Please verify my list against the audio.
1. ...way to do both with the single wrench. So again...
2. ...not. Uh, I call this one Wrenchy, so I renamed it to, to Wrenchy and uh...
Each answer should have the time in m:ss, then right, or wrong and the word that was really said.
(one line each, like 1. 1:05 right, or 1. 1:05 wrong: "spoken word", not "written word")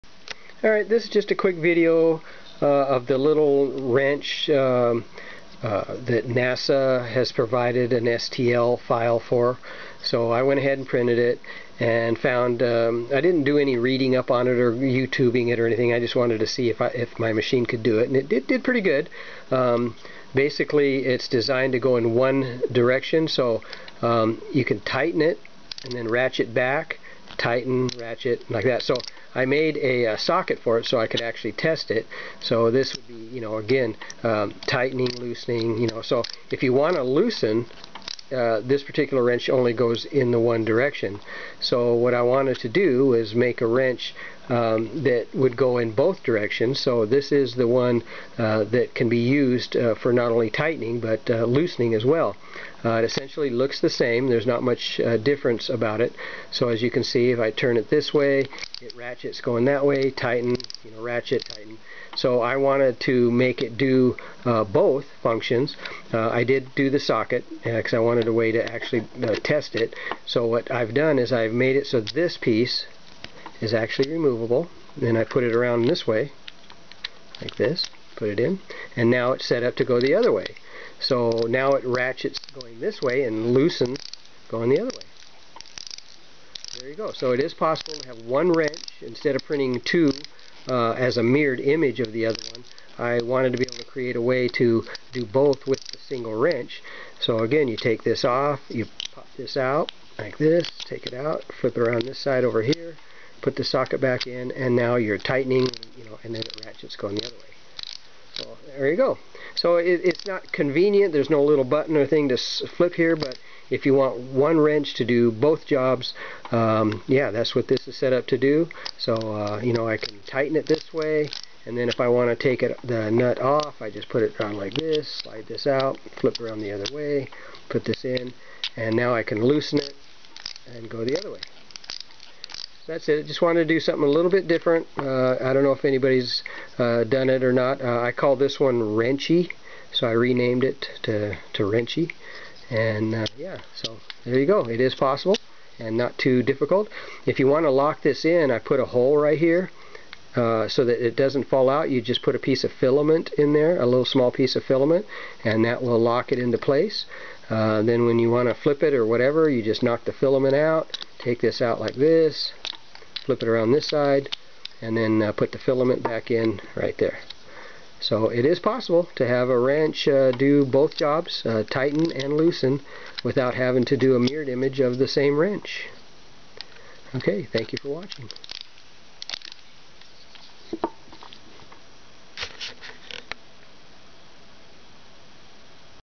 1. 1:34 right
2. 2:17 right.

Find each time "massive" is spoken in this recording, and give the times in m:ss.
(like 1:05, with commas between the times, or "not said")
not said.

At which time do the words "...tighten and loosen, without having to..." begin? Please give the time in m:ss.
2:51.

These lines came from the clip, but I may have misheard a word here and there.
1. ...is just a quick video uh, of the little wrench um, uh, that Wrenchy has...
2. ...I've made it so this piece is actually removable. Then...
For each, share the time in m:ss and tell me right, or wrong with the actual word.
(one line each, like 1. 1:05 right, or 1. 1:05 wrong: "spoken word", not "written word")
1. 0:01 wrong: "NASA", not "Wrenchy"
2. 1:11 right.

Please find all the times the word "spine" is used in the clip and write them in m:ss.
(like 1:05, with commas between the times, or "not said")
not said.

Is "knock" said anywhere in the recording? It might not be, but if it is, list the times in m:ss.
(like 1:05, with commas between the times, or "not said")
2:39.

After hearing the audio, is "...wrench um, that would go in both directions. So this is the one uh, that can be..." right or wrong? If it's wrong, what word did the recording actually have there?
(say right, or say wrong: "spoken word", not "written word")
right.